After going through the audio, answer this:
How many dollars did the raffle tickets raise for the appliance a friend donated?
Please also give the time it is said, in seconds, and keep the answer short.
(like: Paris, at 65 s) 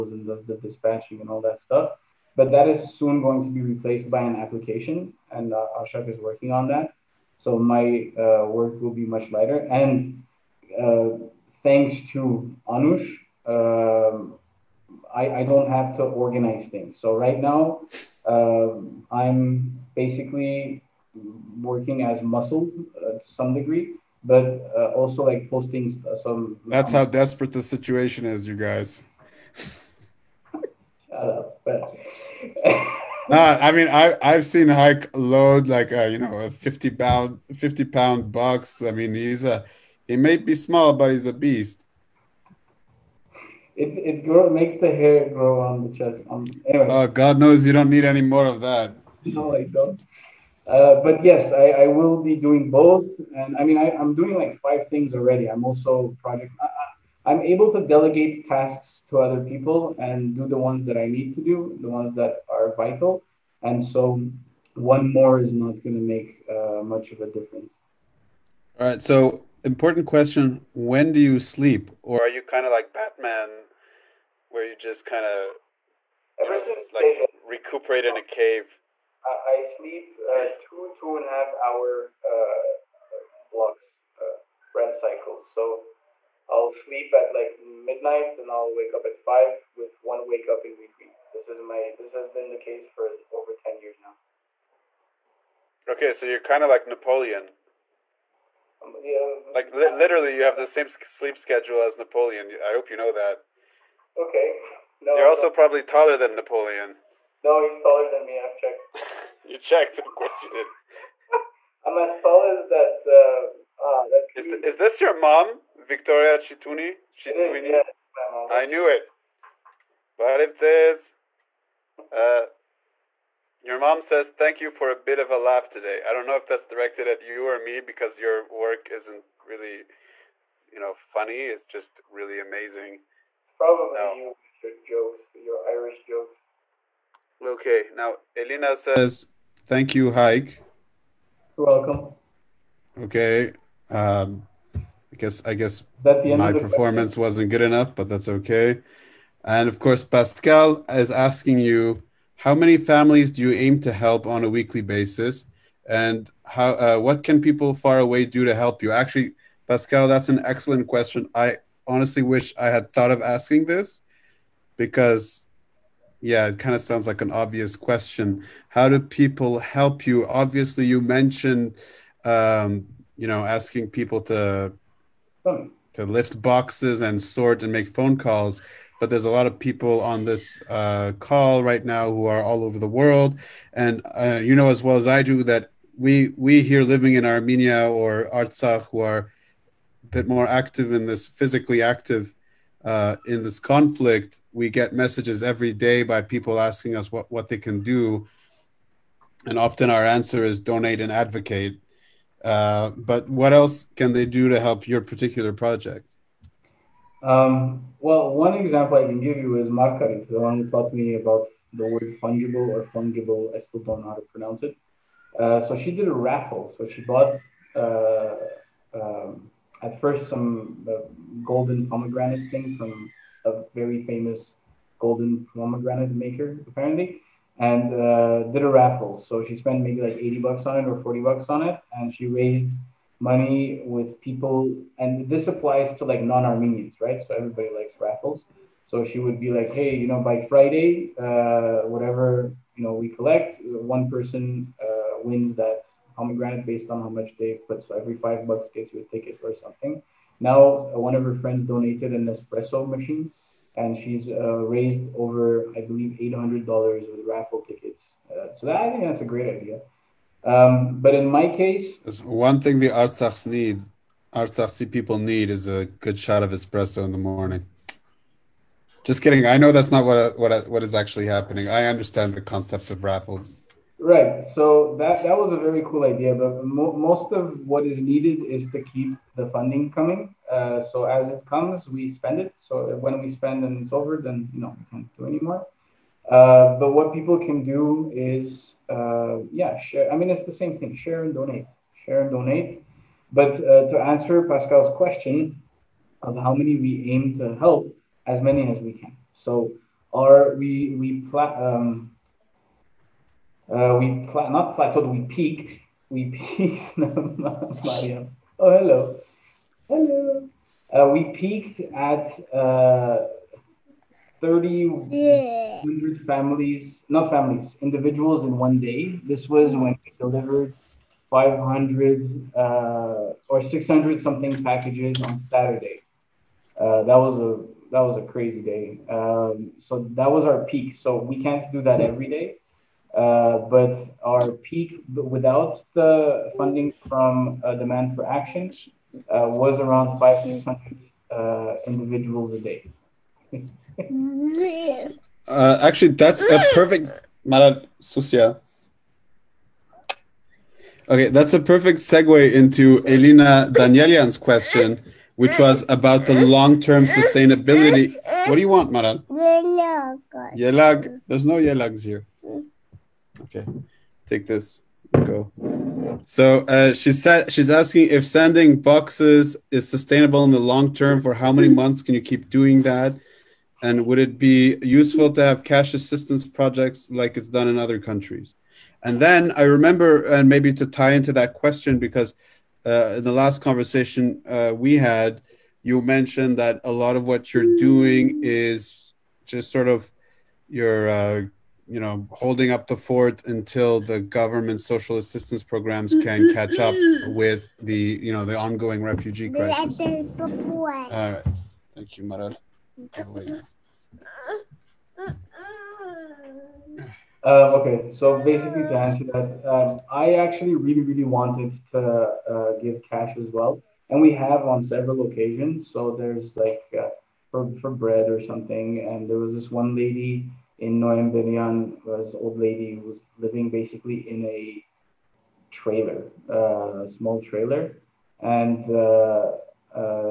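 $800, at 256 s.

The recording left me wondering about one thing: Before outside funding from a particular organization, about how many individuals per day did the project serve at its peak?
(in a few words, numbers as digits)
500.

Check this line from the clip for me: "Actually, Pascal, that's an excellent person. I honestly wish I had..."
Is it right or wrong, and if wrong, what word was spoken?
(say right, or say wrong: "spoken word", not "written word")
wrong: "question", not "person".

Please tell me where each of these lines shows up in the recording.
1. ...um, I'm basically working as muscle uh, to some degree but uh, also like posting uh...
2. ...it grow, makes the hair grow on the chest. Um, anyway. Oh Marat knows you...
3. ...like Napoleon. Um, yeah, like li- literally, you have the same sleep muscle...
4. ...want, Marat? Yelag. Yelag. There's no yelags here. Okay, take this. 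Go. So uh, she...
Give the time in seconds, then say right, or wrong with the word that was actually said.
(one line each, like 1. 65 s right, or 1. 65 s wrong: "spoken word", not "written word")
1. 18 s right
2. 43 s wrong: "God", not "Marat"
3. 96 s wrong: "schedule", not "muscle"
4. 358 s right.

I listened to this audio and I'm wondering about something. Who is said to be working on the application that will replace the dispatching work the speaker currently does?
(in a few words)
Ashok.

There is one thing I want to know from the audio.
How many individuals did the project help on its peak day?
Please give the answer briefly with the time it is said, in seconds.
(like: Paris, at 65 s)
3,100, at 314 s.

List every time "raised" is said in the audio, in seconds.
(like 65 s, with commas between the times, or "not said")
232 s, 254 s.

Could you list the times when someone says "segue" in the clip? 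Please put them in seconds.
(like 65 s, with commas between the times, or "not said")
351 s.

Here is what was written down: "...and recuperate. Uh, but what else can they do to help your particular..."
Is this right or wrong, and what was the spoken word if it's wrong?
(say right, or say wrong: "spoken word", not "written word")
wrong: "advocate", not "recuperate".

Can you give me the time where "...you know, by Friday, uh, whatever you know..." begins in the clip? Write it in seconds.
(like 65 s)
239 s.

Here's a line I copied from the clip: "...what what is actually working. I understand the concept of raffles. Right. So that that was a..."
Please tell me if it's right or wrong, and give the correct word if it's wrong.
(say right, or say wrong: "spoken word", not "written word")
wrong: "happening", not "working".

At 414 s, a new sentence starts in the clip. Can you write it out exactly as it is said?
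And we have on several occasions.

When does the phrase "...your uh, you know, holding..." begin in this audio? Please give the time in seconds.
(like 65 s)
390 s.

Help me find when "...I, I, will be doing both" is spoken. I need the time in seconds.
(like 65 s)
51 s.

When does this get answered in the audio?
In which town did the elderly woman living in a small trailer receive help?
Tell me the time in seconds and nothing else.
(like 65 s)
420 s.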